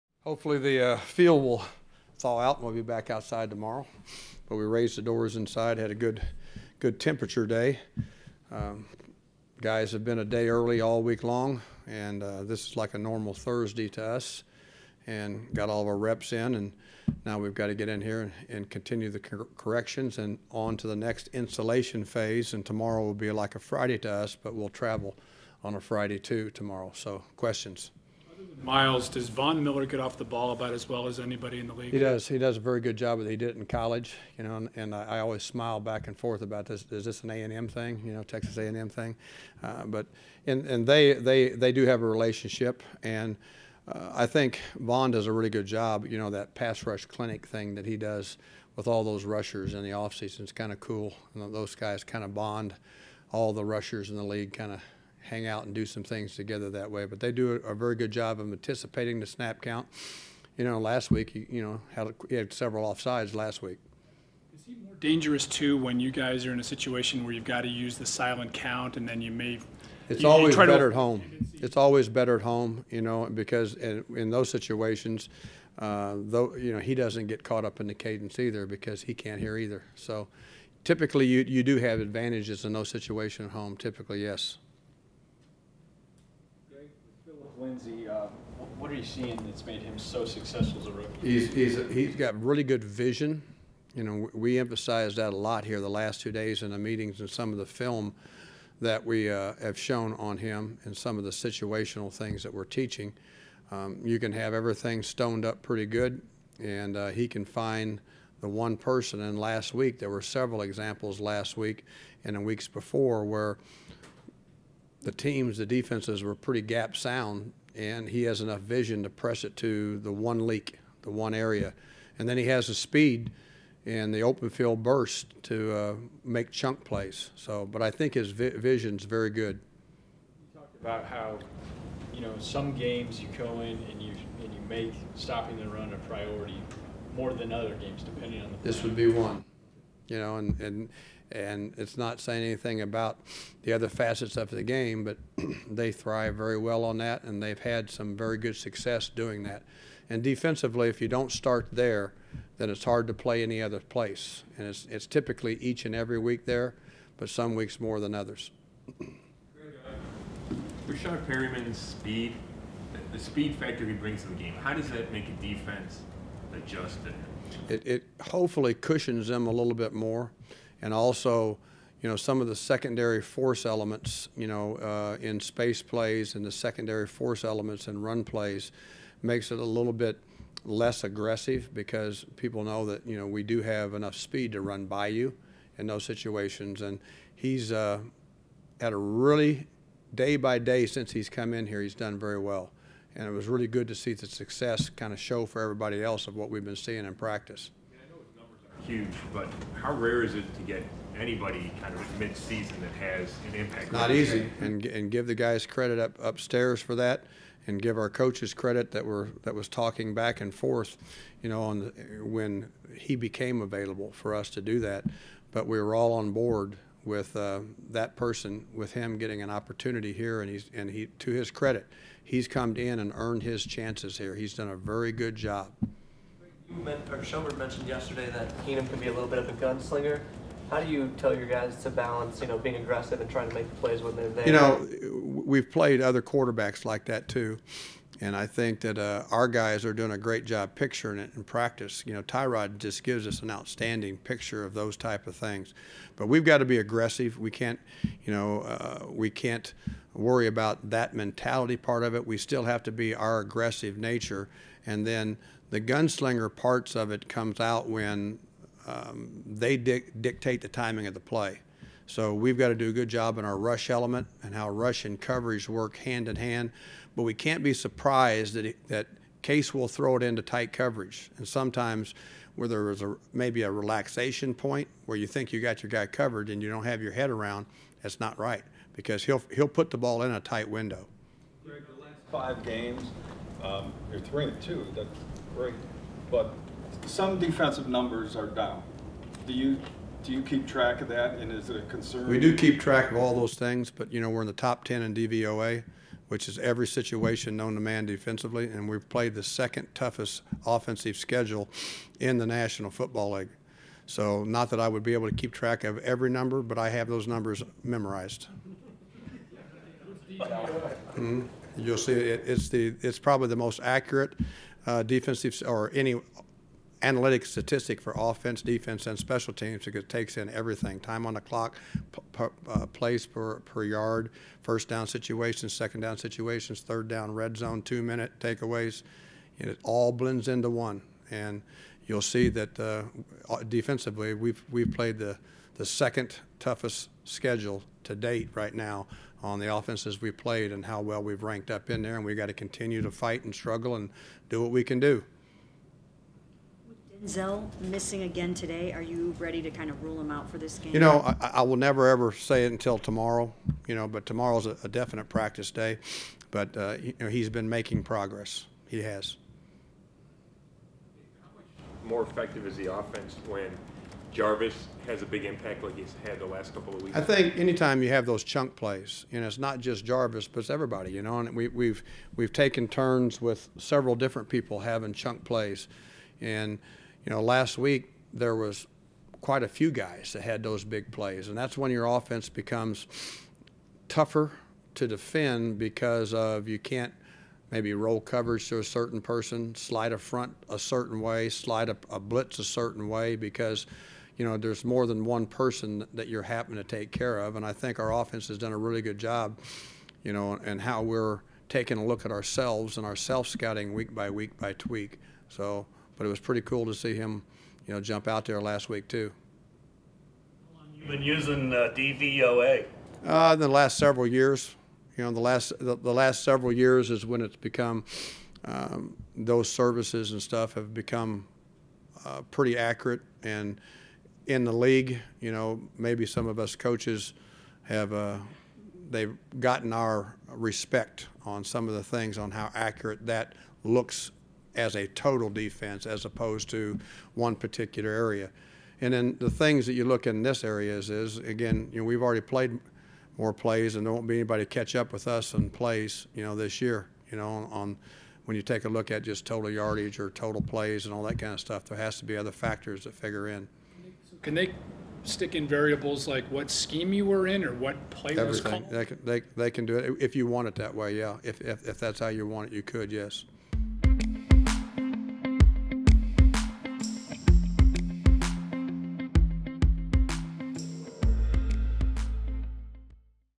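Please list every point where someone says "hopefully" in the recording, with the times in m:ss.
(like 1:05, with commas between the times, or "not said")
0:00, 2:48.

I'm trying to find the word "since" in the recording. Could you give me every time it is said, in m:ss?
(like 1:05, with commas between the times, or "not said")
3:10.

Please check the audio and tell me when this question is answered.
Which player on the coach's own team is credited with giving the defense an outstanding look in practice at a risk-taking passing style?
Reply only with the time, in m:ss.
4:02.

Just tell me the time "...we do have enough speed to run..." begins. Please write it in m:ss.
3:03.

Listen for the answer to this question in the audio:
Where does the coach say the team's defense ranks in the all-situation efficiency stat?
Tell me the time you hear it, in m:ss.
4:54.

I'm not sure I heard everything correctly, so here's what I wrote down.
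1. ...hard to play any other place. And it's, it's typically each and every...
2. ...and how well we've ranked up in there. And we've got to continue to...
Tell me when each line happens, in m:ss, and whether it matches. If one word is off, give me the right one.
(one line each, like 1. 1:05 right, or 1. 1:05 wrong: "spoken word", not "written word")
1. 2:32 right
2. 5:40 right.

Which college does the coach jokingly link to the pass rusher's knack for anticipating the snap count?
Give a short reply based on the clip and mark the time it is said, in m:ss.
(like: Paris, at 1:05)
Texas A&M, at 0:38.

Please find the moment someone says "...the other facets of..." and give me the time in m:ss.
2:23.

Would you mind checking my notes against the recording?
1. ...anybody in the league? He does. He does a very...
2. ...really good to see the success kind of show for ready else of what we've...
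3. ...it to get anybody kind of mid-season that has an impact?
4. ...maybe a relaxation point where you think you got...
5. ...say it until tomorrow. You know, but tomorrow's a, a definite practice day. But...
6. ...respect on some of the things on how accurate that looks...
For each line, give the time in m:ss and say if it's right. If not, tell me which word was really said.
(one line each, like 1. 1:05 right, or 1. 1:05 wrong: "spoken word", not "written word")
1. 0:31 right
2. 3:13 wrong: "everybody", not "ready"
3. 3:20 right
4. 4:33 right
5. 5:52 right
6. 7:10 right.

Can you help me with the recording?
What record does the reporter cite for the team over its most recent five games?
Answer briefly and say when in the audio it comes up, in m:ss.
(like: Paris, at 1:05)
3-2, at 4:44.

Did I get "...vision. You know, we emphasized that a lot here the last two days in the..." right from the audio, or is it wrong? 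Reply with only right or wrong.
right.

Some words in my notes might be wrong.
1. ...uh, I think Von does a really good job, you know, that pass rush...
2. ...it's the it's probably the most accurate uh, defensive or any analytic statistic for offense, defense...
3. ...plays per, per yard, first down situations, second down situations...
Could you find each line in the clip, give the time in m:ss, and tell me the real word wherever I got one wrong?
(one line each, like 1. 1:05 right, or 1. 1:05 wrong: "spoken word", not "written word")
1. 0:43 right
2. 5:12 right
3. 5:22 right.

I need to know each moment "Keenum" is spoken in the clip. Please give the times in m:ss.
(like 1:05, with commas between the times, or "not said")
3:48.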